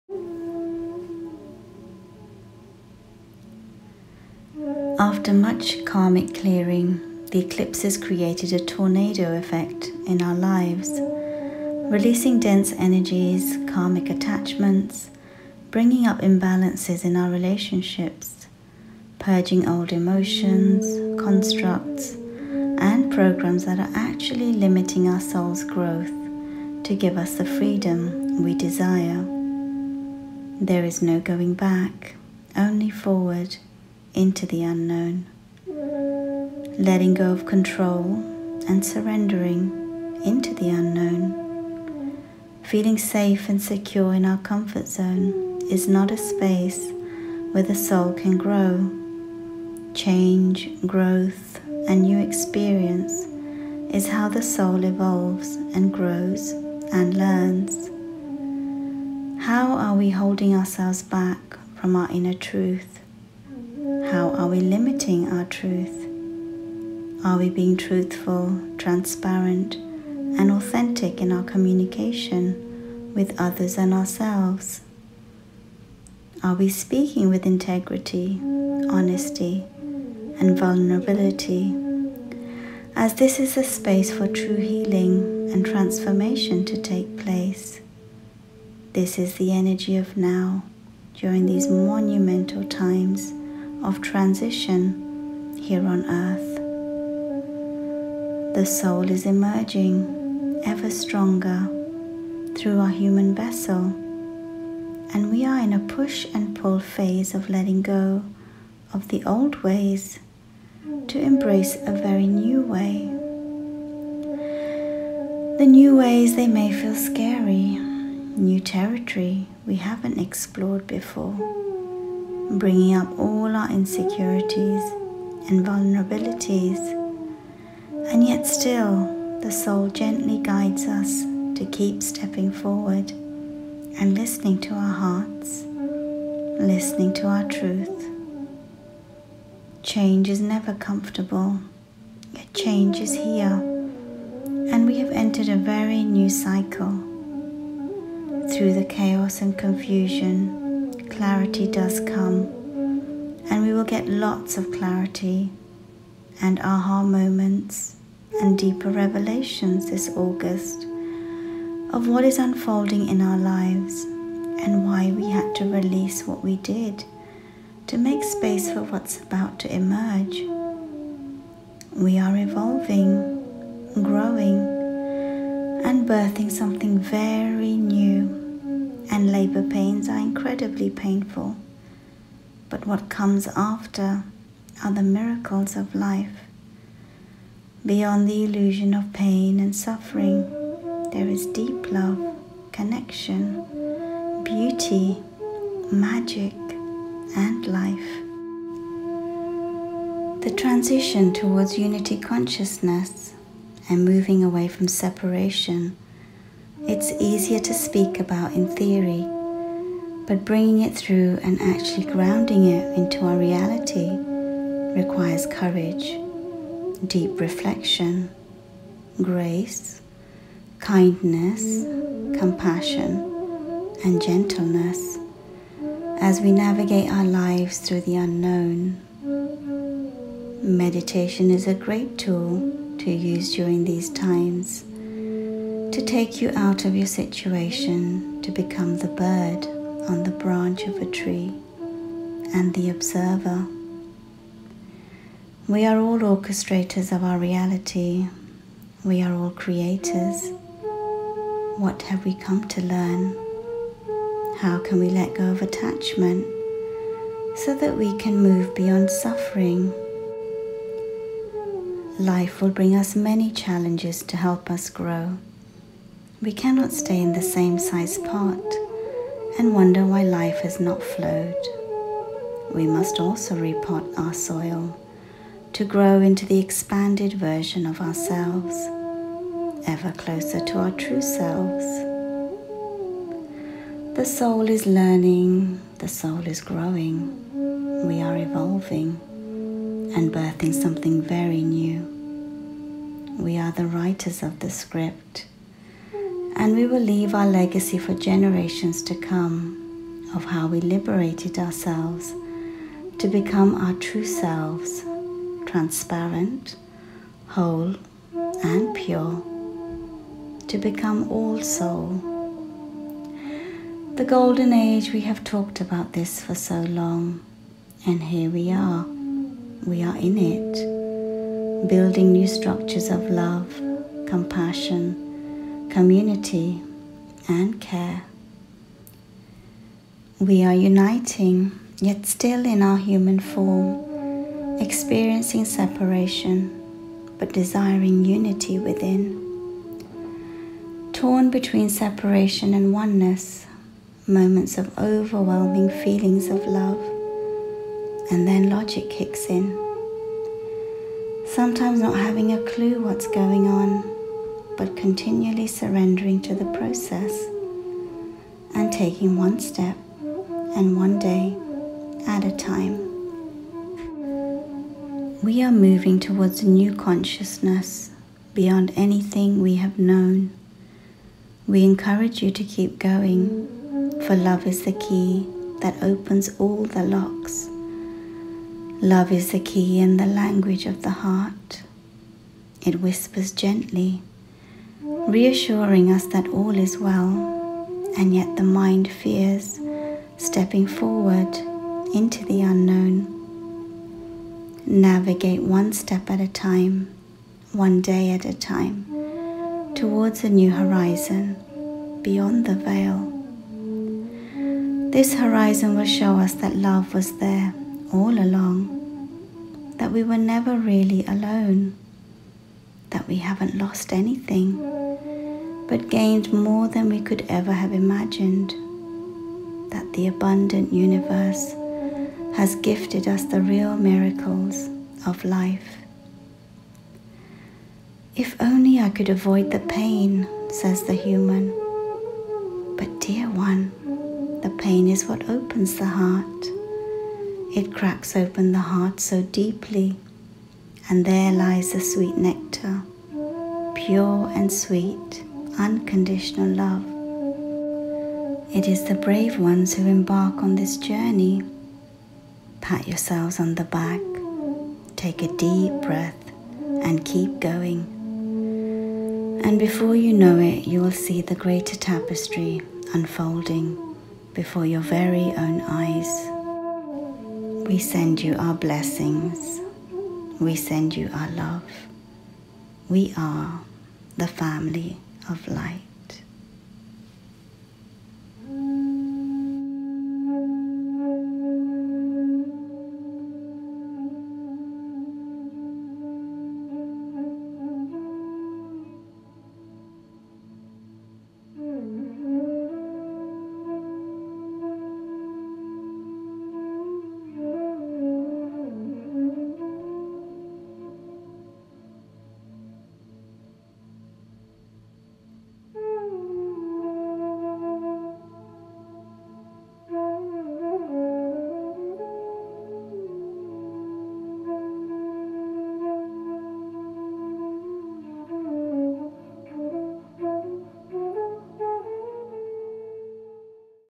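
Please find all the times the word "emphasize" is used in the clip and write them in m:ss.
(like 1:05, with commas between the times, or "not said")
not said.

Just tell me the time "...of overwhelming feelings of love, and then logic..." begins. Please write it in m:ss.
5:44.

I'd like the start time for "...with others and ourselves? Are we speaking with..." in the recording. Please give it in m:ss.
1:13.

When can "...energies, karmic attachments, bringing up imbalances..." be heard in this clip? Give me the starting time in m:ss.
0:12.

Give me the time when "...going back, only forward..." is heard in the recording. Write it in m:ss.
0:31.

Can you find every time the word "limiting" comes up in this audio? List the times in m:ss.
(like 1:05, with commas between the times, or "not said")
0:24, 1:04.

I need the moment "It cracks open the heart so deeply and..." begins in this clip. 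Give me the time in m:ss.
7:17.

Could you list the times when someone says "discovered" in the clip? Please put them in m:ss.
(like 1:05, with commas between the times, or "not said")
not said.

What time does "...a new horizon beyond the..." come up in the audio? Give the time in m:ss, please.
6:40.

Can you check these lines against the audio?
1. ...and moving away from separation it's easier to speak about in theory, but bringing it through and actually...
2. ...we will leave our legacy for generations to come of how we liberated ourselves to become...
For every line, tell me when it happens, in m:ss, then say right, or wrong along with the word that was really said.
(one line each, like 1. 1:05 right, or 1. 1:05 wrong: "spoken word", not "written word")
1. 3:23 right
2. 4:56 right.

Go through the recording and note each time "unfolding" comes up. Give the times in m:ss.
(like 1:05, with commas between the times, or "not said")
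2:42, 7:43.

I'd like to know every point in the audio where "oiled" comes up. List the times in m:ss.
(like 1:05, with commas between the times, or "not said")
not said.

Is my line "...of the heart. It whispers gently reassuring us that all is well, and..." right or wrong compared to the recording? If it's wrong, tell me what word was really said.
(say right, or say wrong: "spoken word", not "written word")
right.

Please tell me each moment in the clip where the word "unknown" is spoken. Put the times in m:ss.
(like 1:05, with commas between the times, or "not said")
0:34, 0:40, 3:48, 6:32.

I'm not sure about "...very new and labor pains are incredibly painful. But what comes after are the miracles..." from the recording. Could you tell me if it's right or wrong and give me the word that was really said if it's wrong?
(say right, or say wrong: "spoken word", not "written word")
right.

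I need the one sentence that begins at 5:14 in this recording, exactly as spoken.
The golden age, we have talked about this for so long, and here we are.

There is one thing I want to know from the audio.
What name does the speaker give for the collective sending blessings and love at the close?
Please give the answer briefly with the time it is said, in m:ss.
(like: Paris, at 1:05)
the family of light, at 7:54.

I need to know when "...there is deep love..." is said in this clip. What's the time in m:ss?
3:11.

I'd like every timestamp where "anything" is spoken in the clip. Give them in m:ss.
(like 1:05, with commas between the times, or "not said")
6:08, 6:54.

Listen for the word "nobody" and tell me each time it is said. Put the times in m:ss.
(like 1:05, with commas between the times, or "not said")
not said.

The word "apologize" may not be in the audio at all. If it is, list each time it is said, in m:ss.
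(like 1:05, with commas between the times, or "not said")
not said.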